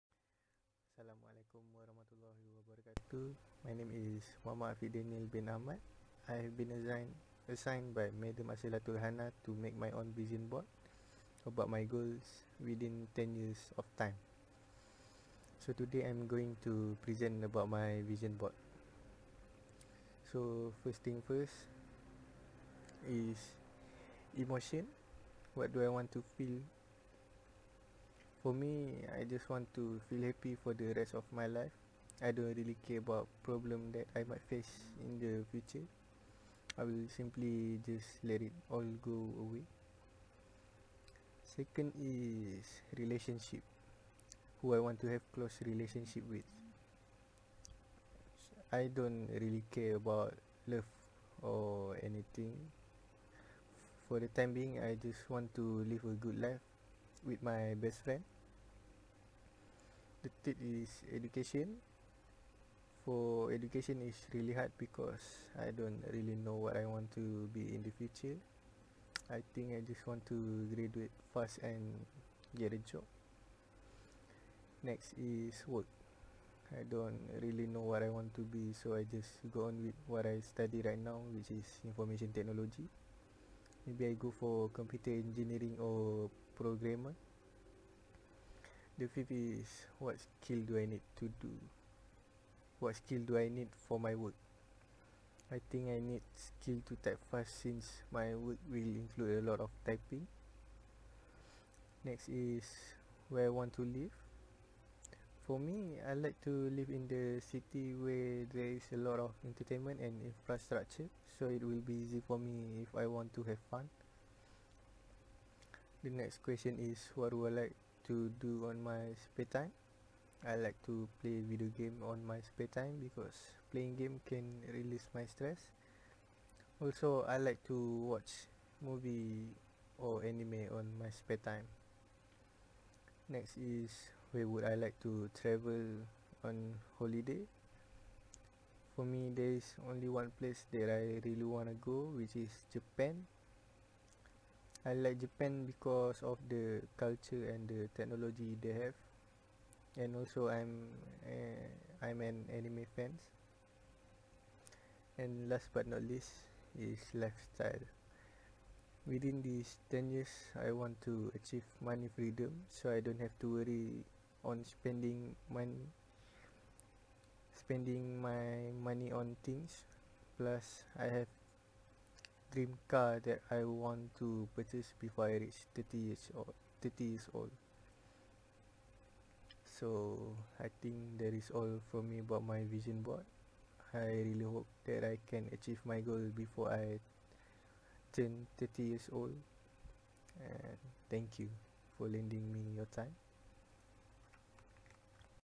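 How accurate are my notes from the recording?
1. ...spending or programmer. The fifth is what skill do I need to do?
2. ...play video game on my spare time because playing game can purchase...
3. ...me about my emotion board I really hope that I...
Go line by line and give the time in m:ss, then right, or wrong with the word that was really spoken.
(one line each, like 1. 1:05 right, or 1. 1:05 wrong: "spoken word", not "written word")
1. 1:25 wrong: "engineering", not "spending"
2. 2:01 wrong: "release", not "purchase"
3. 3:02 wrong: "vision", not "emotion".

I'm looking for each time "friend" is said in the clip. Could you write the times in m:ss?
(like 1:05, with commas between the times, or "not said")
0:58.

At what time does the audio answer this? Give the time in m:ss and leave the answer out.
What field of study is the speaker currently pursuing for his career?
1:21.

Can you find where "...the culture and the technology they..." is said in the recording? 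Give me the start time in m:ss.
2:26.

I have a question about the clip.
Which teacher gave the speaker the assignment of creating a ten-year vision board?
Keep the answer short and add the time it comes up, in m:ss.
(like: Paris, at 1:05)
Madam Asilatul Hana, at 0:08.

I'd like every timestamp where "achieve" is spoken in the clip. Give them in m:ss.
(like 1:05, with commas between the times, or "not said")
2:41, 3:05.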